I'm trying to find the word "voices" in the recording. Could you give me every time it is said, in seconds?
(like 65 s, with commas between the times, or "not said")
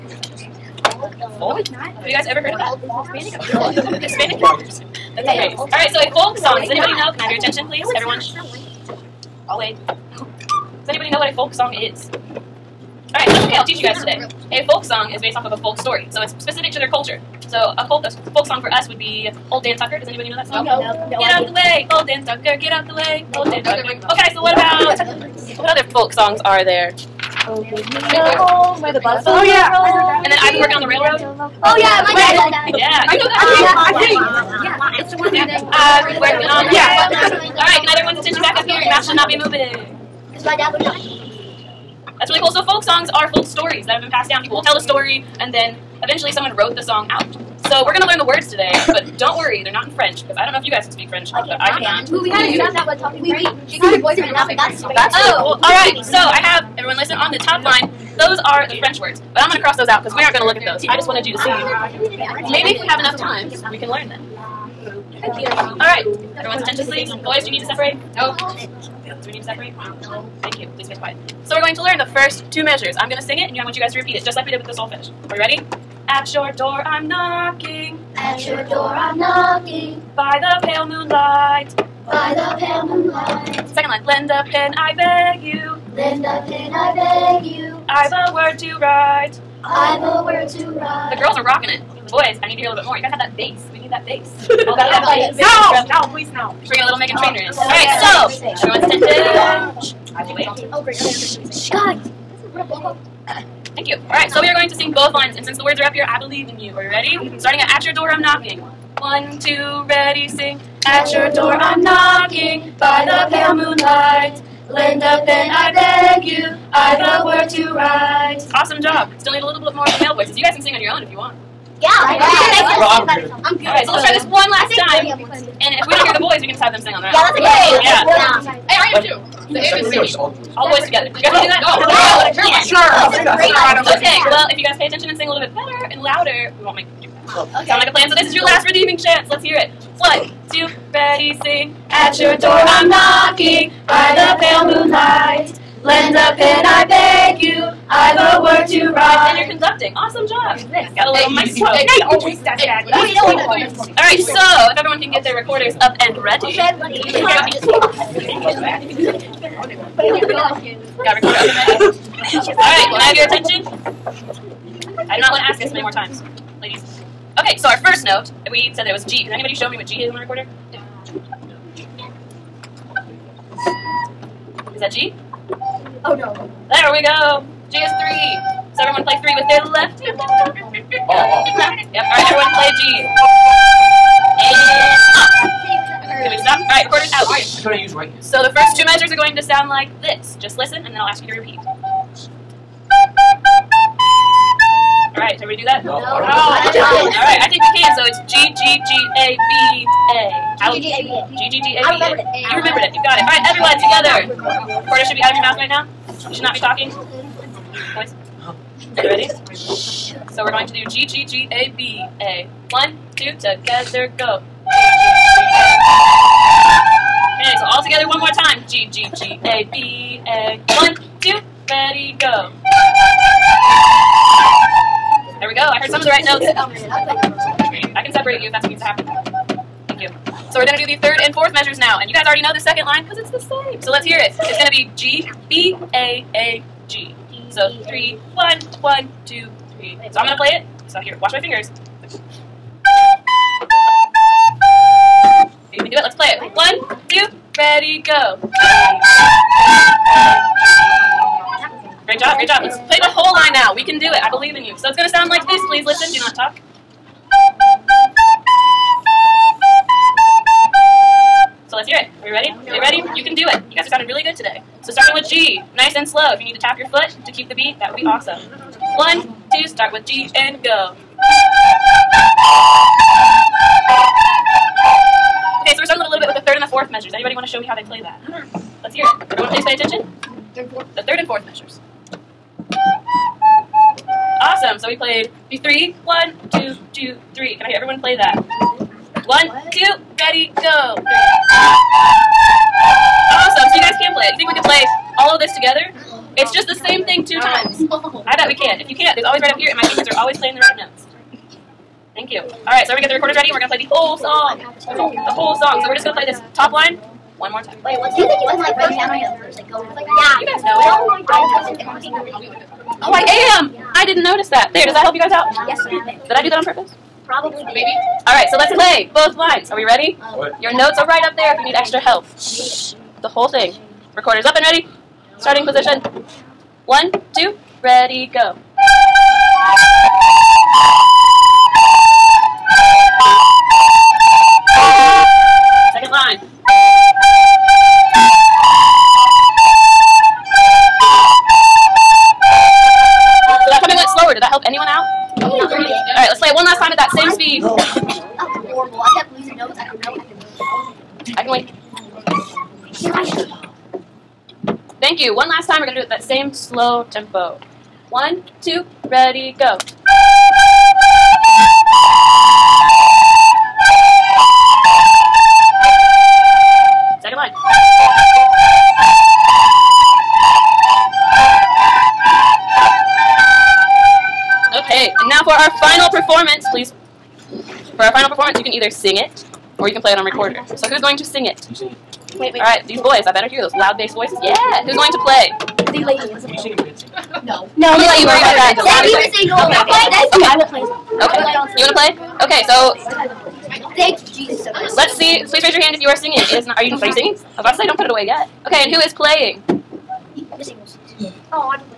120 s, 384 s.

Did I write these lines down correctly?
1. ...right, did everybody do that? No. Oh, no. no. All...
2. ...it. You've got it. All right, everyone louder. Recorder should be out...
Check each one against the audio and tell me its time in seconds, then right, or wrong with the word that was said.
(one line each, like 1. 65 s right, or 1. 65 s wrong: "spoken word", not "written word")
1. 195 s right
2. 202 s wrong: "together", not "louder".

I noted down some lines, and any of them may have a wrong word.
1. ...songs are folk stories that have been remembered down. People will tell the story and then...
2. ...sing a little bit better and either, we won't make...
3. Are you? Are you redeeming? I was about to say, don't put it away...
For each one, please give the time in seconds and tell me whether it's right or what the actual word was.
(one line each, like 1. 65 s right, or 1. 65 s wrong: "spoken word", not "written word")
1. 42 s wrong: "passed", not "remembered"
2. 135 s wrong: "louder", not "either"
3. 396 s wrong: "singing", not "redeeming".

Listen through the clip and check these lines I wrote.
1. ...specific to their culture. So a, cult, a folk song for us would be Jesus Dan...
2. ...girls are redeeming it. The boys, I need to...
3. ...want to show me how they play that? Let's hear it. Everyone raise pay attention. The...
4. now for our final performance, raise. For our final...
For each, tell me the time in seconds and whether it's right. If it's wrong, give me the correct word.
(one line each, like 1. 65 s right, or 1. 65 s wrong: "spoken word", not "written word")
1. 16 s wrong: "Old", not "Jesus"
2. 91 s wrong: "rocking", not "redeeming"
3. 277 s wrong: "please", not "raise"
4. 375 s wrong: "please", not "raise".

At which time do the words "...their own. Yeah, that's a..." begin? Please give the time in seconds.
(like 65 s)
127 s.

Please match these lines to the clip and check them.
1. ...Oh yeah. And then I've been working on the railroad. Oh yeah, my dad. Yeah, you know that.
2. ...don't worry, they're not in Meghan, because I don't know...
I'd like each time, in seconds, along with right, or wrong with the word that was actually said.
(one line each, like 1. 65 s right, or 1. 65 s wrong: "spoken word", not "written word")
1. 29 s right
2. 49 s wrong: "French", not "Meghan".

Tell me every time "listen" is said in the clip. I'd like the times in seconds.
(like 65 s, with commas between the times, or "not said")
56 s, 190 s, 255 s.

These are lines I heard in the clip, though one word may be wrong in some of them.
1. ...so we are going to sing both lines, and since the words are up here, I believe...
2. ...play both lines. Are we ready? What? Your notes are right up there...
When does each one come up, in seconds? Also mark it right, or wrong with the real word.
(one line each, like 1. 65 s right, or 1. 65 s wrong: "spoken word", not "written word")
1. 104 s right
2. 318 s right.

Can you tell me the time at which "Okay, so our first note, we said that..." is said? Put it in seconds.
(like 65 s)
167 s.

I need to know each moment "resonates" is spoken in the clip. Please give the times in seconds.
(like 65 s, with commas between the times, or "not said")
not said.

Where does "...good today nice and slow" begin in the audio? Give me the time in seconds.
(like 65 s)
264 s.